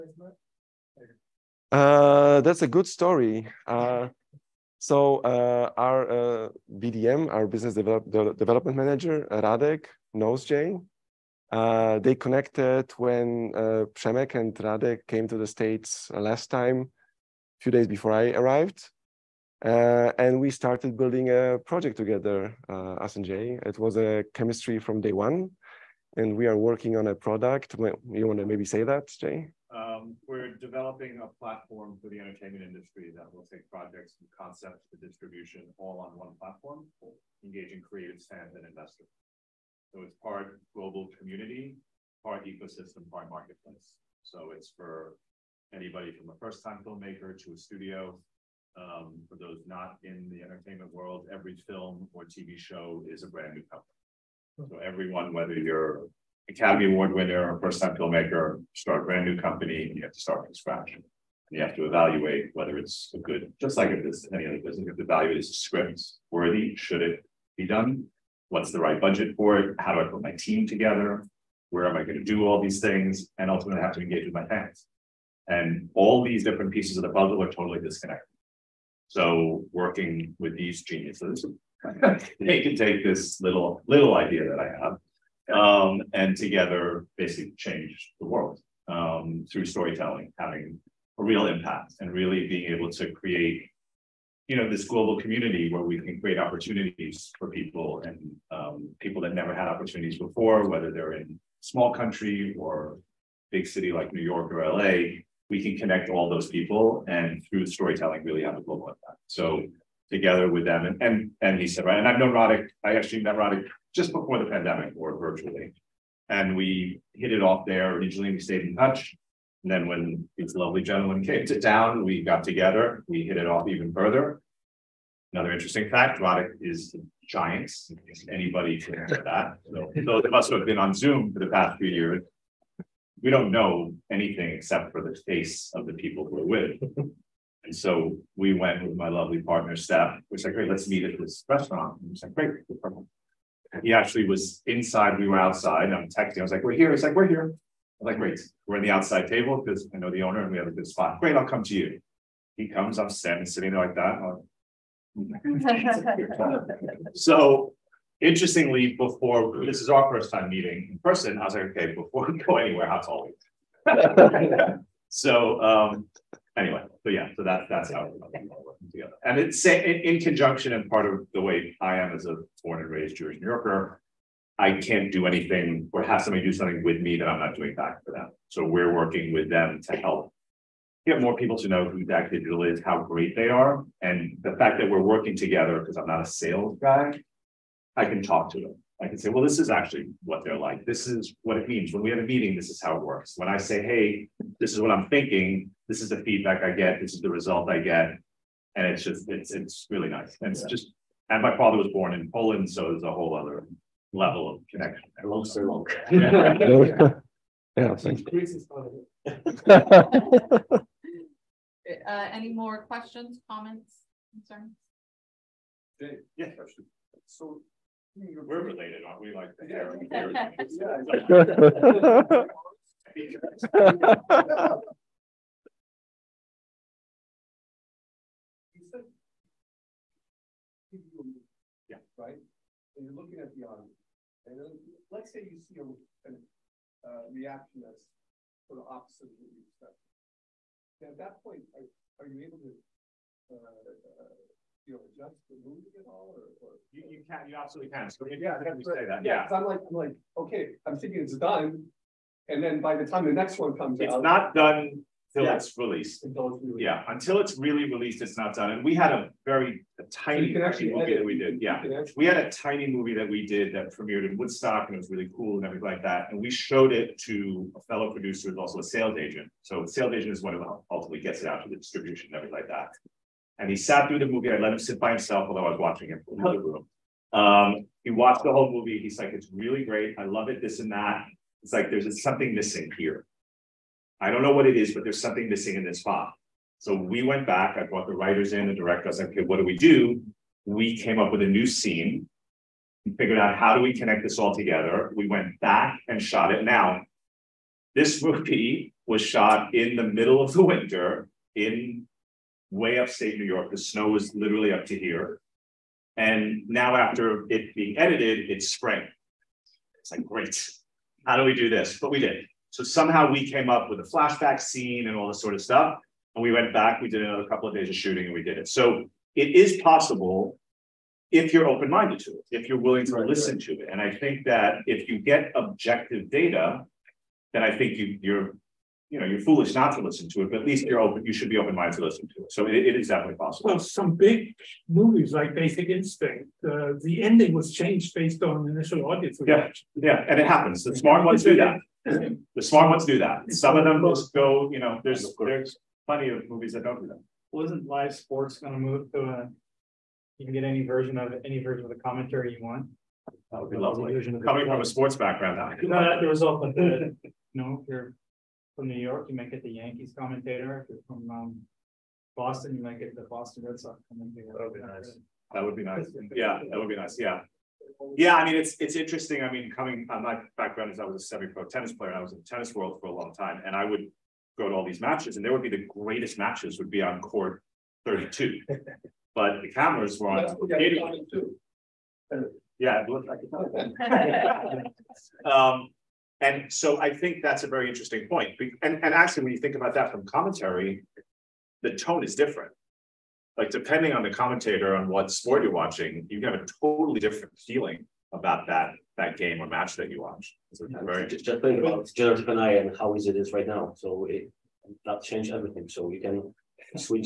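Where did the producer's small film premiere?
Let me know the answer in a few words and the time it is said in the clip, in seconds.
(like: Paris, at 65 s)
Woodstock, at 264 s.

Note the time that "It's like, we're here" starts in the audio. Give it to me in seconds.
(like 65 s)
146 s.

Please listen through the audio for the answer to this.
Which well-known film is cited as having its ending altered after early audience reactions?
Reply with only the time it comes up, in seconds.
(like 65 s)
335 s.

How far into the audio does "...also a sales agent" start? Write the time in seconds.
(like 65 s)
268 s.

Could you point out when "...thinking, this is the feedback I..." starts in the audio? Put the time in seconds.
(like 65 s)
195 s.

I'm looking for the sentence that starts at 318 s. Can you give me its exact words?
So it is possible if you're open-minded to it, if you're willing to right, listen right.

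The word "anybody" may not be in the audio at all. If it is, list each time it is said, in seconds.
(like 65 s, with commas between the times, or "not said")
45 s, 128 s.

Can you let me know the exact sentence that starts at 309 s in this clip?
It's like, great, how do we do this?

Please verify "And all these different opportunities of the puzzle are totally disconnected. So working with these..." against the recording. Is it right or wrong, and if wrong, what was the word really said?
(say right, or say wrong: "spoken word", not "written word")
wrong: "pieces", not "opportunities".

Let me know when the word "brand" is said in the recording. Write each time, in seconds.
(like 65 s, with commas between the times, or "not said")
53 s, 59 s.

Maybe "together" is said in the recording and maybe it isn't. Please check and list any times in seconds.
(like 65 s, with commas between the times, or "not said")
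21 s, 70 s, 86 s, 110 s, 122 s, 168 s, 185 s, 294 s.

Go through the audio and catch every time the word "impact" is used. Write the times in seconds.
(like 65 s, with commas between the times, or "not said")
91 s, 108 s.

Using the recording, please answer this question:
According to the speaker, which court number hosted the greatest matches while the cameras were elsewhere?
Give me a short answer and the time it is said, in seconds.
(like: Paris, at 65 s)
32, at 377 s.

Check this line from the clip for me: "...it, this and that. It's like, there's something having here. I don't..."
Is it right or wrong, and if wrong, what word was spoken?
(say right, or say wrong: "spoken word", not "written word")
wrong: "missing", not "having".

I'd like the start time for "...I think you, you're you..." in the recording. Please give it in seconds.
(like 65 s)
327 s.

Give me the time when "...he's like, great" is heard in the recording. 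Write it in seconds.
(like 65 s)
142 s.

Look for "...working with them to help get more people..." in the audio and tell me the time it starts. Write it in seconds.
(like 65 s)
178 s.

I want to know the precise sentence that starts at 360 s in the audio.
If you're from um, Boston, you might get the Boston Red Sox commentator.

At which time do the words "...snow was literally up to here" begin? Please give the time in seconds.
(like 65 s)
303 s.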